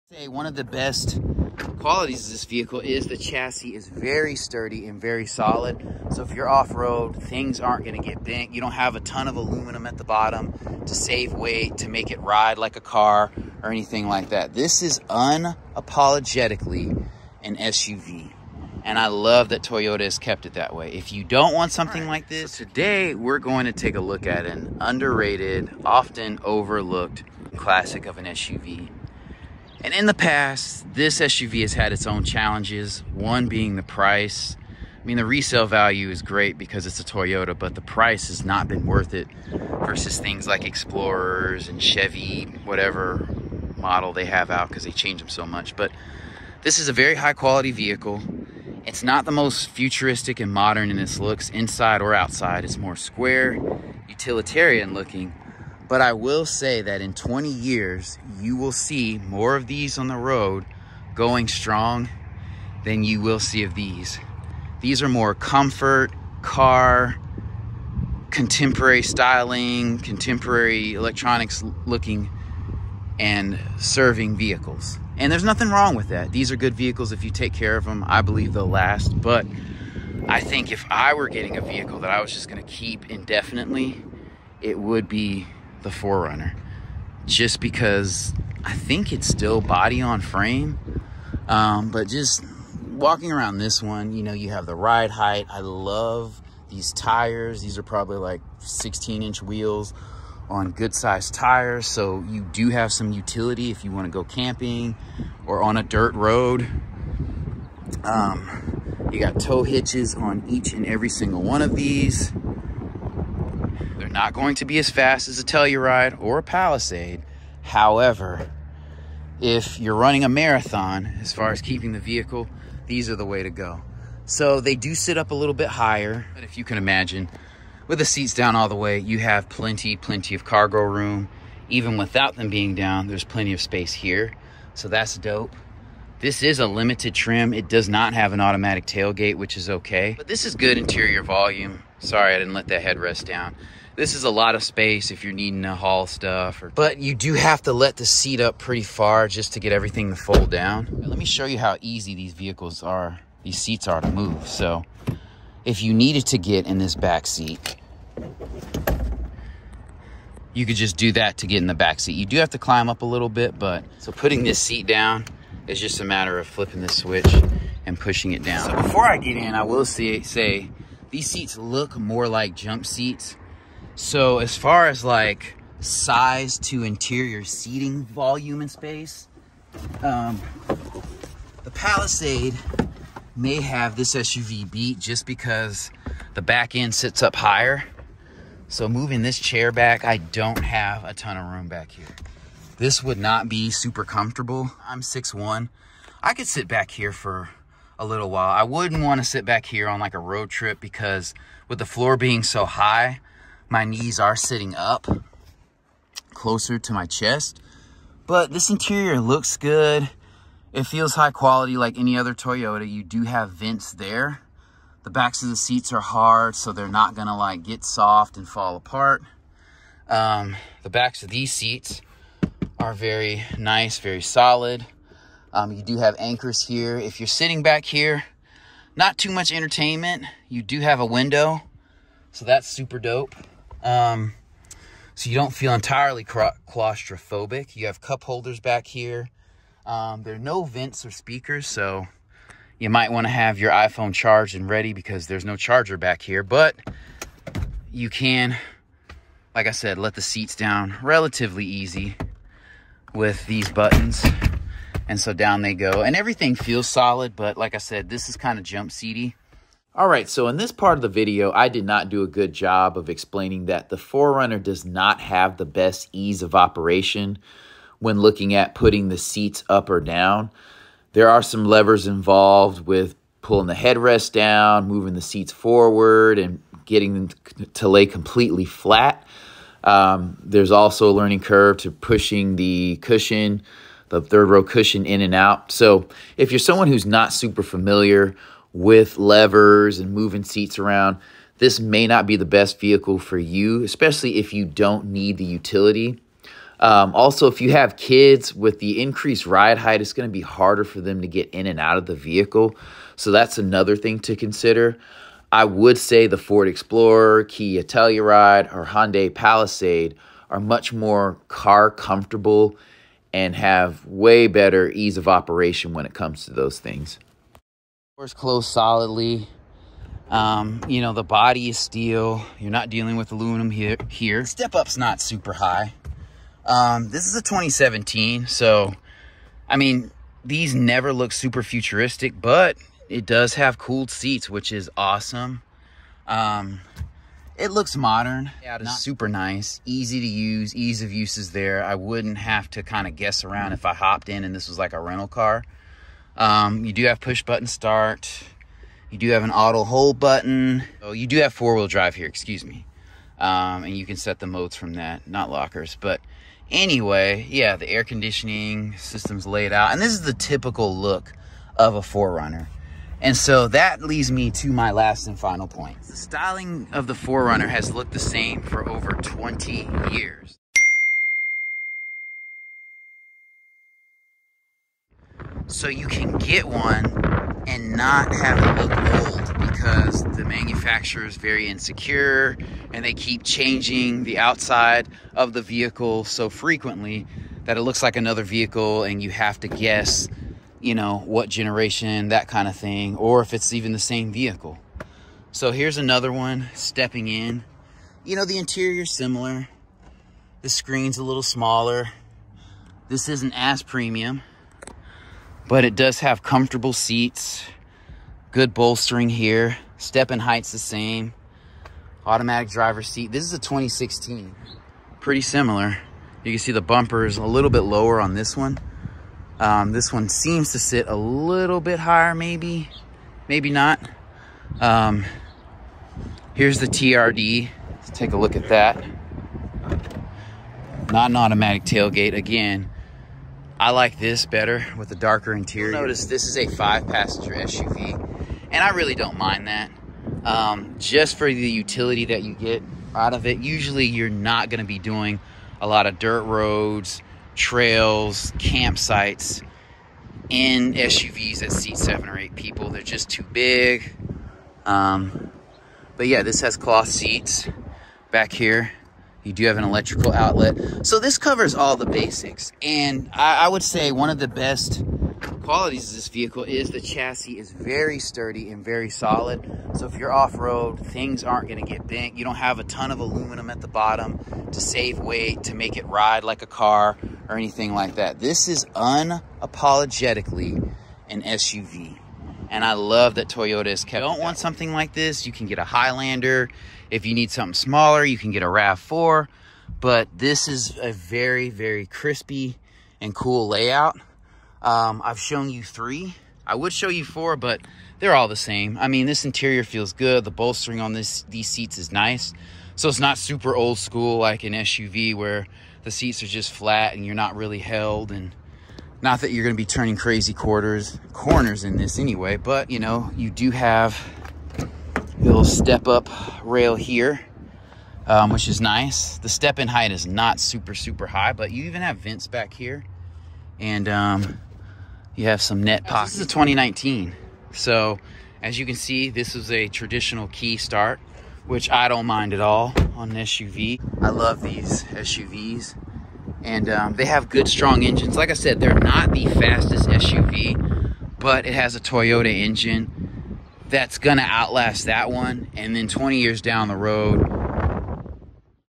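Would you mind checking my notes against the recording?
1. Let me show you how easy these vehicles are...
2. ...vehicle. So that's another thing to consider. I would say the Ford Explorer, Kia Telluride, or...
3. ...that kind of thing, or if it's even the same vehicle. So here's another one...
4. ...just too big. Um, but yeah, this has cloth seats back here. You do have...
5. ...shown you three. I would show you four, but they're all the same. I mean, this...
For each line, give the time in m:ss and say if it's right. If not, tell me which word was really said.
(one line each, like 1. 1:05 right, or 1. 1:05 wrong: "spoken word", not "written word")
1. 2:31 right
2. 5:02 right
3. 6:32 right
4. 7:33 right
5. 8:15 right.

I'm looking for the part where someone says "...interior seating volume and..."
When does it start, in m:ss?
2:56.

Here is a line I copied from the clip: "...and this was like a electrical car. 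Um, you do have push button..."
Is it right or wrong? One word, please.
wrong.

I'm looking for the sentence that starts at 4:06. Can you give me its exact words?
But you can, like I said, let the seats down relatively easy with these buttons.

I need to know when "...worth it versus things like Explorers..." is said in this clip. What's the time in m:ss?
0:38.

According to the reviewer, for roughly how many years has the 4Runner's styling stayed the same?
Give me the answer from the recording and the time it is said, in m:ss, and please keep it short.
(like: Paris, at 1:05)
20 years, at 6:08.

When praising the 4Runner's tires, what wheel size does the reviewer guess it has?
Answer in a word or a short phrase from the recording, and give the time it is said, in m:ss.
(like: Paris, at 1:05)
16 inch, at 1:38.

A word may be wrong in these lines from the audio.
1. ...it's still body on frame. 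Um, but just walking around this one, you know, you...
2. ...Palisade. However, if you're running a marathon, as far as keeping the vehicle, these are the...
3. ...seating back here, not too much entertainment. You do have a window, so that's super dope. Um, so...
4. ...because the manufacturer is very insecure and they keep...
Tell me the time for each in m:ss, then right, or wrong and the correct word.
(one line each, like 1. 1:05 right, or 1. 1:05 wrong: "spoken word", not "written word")
1. 1:29 right
2. 1:56 right
3. 3:47 wrong: "sitting", not "seating"
4. 6:19 right.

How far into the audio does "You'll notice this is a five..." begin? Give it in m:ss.
7:15.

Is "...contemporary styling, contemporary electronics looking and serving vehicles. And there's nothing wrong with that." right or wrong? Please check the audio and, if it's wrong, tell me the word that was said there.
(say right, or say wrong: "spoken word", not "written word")
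right.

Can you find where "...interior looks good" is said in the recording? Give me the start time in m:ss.
3:28.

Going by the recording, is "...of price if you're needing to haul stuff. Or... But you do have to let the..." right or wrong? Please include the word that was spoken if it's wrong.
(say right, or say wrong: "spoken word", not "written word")
wrong: "space", not "price".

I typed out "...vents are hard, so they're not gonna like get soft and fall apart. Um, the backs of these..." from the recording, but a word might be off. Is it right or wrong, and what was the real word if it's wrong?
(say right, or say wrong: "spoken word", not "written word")
wrong: "seats", not "vents".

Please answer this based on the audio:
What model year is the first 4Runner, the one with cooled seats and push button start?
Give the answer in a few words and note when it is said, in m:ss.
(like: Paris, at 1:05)
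2017, at 5:27.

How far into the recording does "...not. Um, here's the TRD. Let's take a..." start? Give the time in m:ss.
7:03.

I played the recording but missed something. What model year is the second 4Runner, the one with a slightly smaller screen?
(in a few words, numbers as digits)
2016.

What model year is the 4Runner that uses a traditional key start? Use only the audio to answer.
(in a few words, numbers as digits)
2019.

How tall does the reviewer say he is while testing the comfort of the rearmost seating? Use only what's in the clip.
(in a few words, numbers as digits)
6'1".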